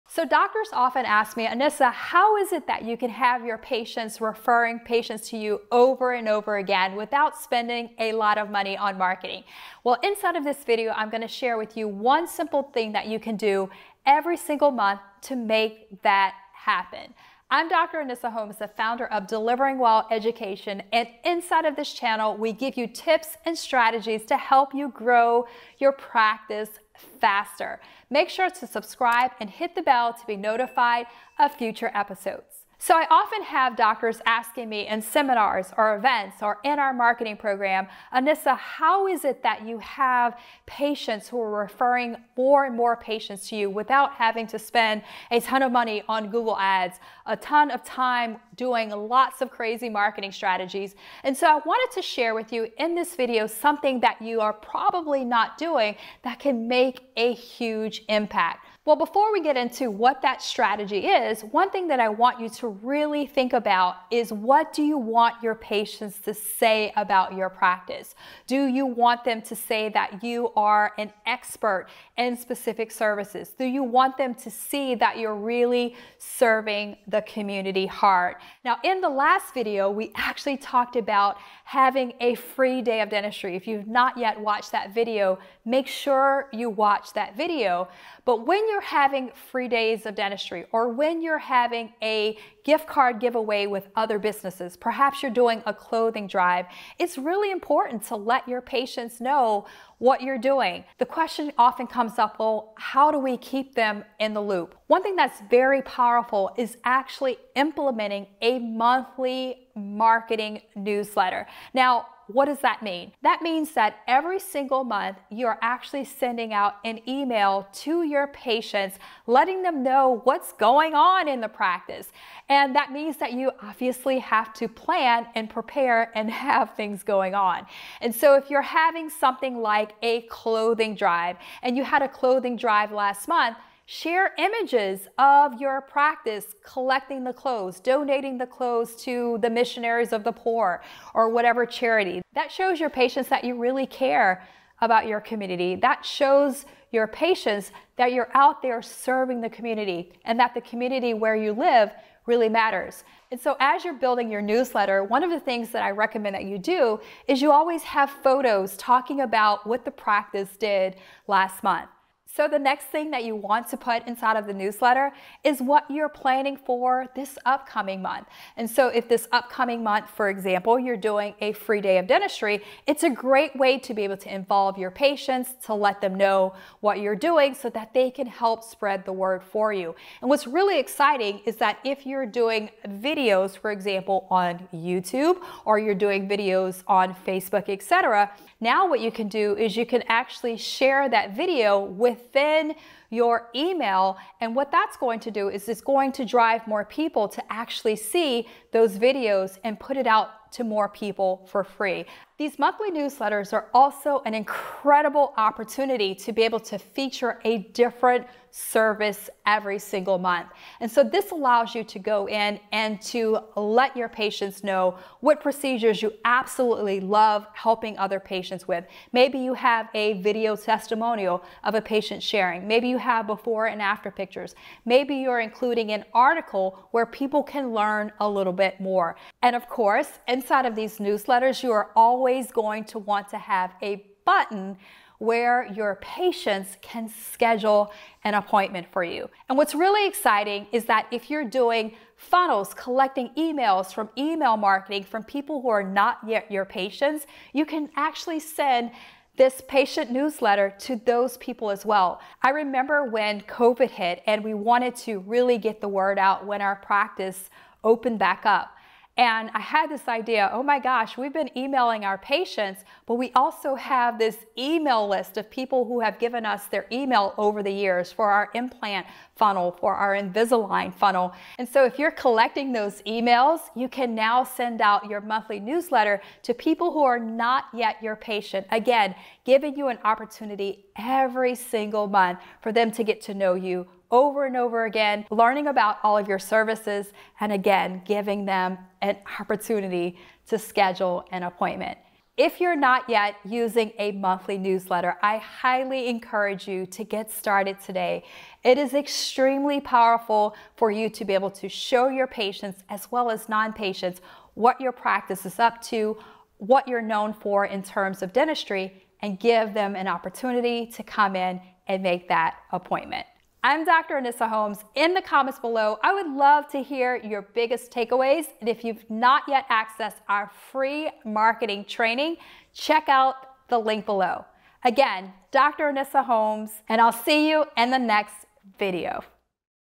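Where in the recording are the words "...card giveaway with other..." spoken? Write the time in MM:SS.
01:32.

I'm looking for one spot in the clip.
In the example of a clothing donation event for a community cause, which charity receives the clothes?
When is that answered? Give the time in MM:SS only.
02:19.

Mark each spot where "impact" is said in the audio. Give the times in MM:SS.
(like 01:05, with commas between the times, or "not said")
00:58.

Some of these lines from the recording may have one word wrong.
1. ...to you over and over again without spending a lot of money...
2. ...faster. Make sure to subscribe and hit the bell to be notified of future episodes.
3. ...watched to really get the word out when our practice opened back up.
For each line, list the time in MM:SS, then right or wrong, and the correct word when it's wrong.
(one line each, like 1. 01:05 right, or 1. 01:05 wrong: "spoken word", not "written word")
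1. 00:05 right
2. 00:27 right
3. 04:14 wrong: "wanted", not "watched".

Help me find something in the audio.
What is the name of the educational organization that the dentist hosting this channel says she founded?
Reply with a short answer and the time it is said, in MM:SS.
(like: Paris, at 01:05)
Delivering WOW Education, at 00:19.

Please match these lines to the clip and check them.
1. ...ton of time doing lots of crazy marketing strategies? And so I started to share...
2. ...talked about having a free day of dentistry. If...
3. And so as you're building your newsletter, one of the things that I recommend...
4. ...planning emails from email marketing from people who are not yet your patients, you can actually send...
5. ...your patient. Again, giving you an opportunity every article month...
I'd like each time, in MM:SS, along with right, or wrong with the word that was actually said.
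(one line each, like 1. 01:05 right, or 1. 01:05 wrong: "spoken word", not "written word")
1. 00:47 wrong: "wanted", not "started"
2. 01:20 right
3. 02:33 right
4. 04:02 wrong: "collecting", not "planning"
5. 04:38 wrong: "single", not "article".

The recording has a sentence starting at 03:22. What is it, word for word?
These monthly newsletters are also an incredible opportunity to be able to feature a different service every single month.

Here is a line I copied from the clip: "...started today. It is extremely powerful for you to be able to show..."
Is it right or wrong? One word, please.
right.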